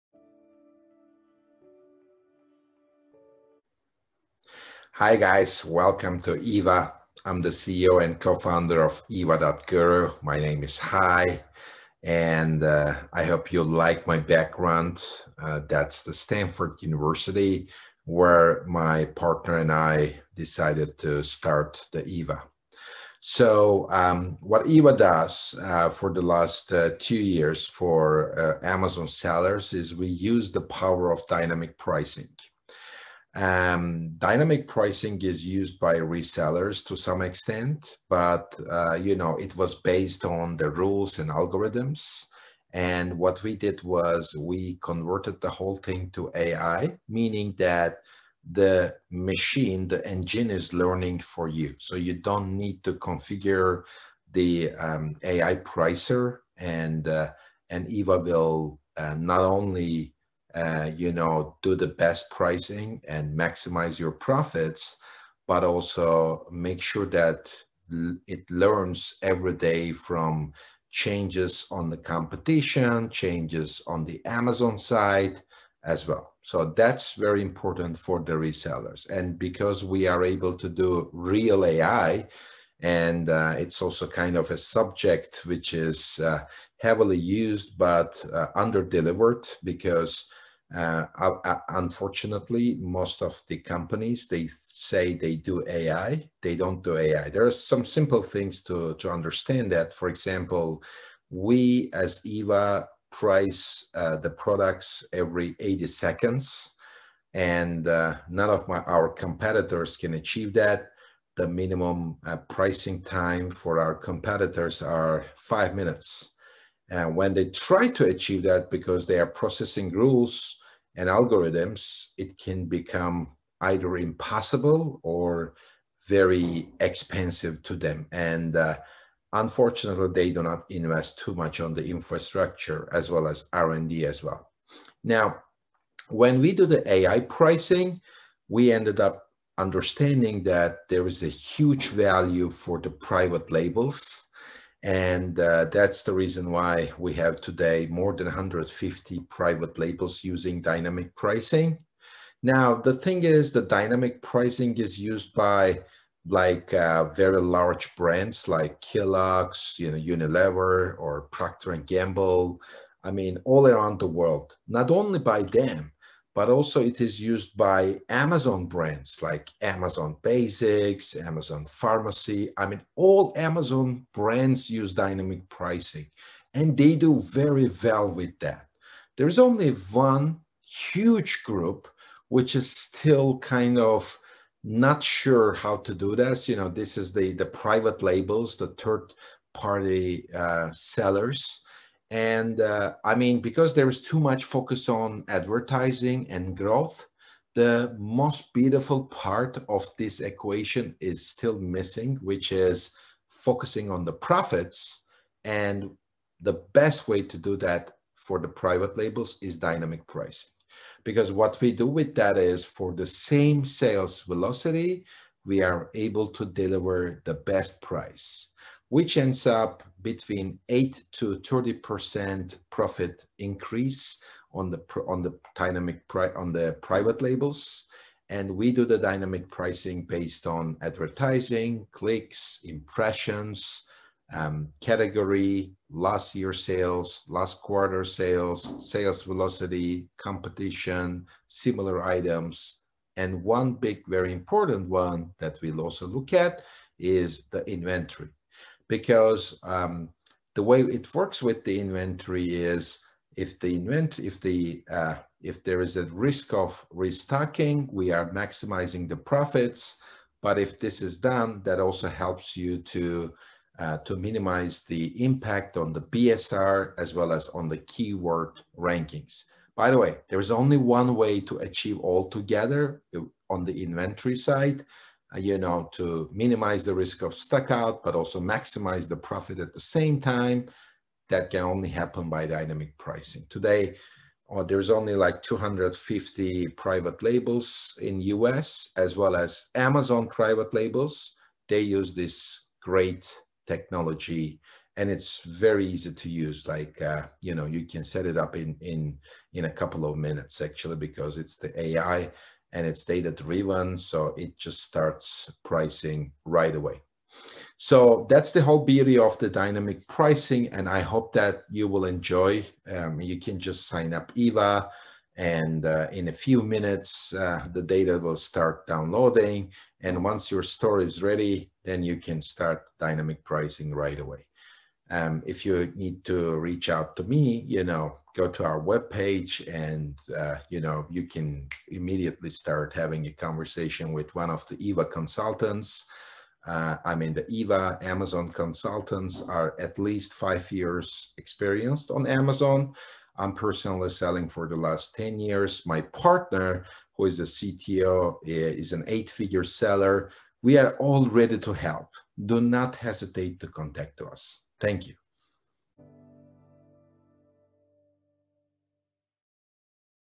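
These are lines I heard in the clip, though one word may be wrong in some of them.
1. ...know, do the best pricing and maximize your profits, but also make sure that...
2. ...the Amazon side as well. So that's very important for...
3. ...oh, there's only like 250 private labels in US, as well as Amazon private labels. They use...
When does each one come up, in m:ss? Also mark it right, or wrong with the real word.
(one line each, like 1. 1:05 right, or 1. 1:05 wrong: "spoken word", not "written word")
1. 1:01 right
2. 1:14 right
3. 4:44 right.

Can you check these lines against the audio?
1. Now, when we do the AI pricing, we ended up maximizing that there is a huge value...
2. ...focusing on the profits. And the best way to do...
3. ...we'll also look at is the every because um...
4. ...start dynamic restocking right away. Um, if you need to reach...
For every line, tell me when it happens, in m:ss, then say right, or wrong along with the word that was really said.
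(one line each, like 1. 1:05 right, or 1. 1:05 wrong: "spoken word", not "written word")
1. 2:15 wrong: "understanding", not "maximizing"
2. 3:23 right
3. 4:05 wrong: "inventory", not "every"
4. 5:22 wrong: "pricing", not "restocking".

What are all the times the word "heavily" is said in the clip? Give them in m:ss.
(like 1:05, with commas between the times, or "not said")
1:26.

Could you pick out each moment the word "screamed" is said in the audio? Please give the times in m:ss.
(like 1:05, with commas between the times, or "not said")
not said.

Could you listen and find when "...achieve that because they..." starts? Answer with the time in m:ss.
1:58.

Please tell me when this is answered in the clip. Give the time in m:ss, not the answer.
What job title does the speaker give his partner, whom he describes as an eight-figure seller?
5:47.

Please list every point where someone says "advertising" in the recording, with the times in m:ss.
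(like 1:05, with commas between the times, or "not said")
3:15, 3:50.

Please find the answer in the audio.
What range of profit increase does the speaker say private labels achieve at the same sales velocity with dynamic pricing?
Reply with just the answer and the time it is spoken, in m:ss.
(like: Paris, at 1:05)
8 to 30%, at 3:40.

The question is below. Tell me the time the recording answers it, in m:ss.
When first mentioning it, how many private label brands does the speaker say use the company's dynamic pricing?
2:27.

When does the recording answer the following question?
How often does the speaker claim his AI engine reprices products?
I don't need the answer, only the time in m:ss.
1:45.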